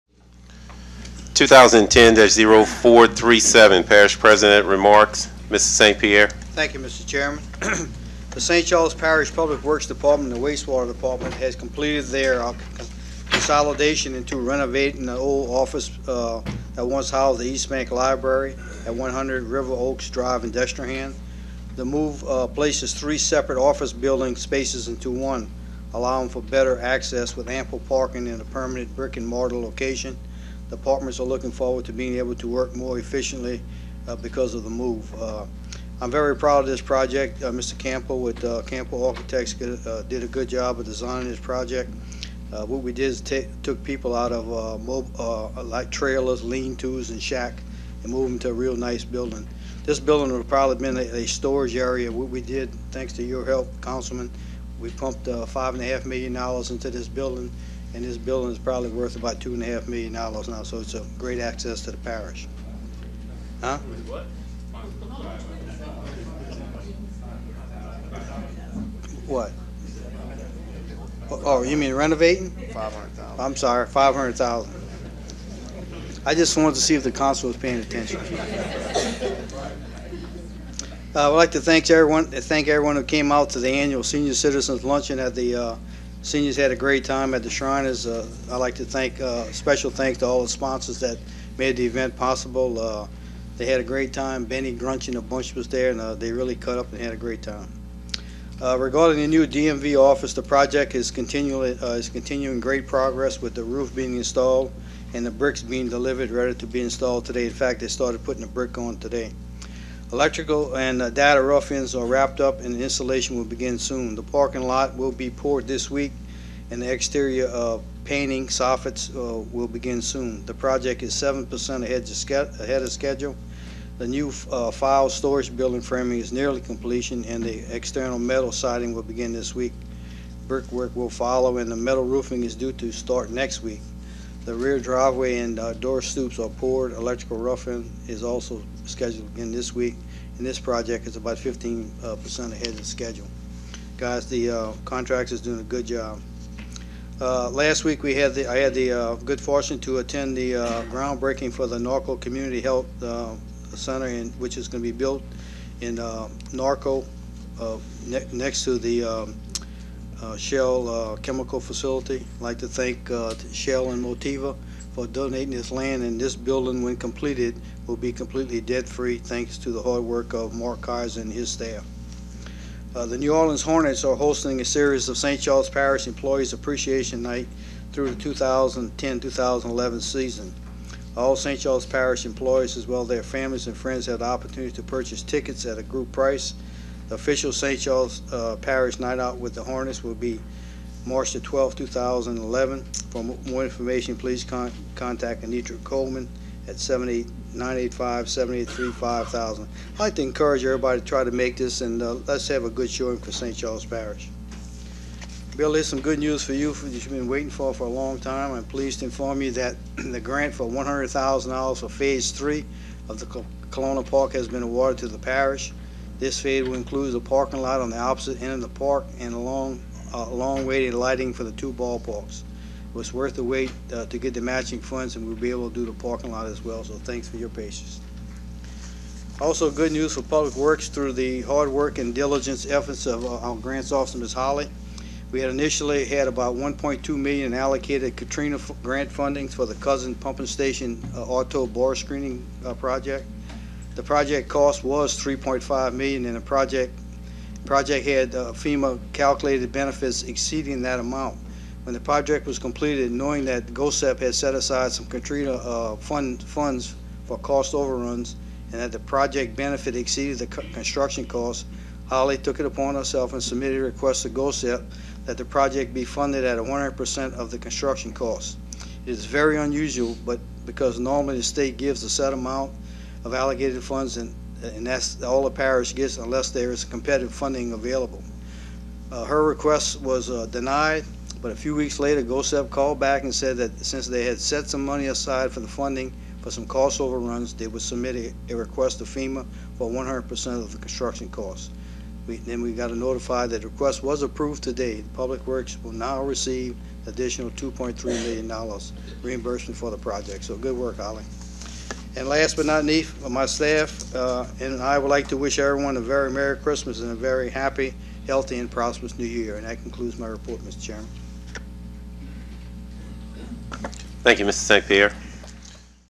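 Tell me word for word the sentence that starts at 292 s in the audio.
We, then we got to notify that the request was approved today.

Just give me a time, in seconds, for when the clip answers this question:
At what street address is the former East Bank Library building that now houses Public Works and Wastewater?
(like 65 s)
18 s.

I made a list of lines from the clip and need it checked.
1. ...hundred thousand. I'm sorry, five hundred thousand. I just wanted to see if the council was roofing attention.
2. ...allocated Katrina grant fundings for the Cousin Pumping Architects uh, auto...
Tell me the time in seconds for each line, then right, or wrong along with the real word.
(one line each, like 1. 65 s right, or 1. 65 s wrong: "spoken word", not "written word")
1. 72 s wrong: "paying", not "roofing"
2. 237 s wrong: "Station", not "Architects".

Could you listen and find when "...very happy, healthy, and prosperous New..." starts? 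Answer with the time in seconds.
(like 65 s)
307 s.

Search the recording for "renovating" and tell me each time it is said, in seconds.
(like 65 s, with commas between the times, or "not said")
14 s, 71 s.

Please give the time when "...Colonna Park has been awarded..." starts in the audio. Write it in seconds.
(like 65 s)
213 s.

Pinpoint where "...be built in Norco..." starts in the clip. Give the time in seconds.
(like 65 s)
154 s.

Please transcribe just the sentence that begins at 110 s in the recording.
Electrical and uh, data rough-ins are wrapped up and installation will begin soon.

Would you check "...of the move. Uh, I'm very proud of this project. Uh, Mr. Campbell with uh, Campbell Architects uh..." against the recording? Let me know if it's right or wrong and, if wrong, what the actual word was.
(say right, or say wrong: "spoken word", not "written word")
right.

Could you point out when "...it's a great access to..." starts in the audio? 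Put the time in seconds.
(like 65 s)
60 s.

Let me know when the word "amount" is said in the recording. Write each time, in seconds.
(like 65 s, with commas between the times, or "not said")
251 s, 272 s.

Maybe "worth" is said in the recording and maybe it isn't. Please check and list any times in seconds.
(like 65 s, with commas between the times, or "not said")
58 s, 223 s.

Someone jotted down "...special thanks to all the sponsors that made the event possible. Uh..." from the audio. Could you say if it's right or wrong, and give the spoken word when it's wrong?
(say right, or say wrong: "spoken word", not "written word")
right.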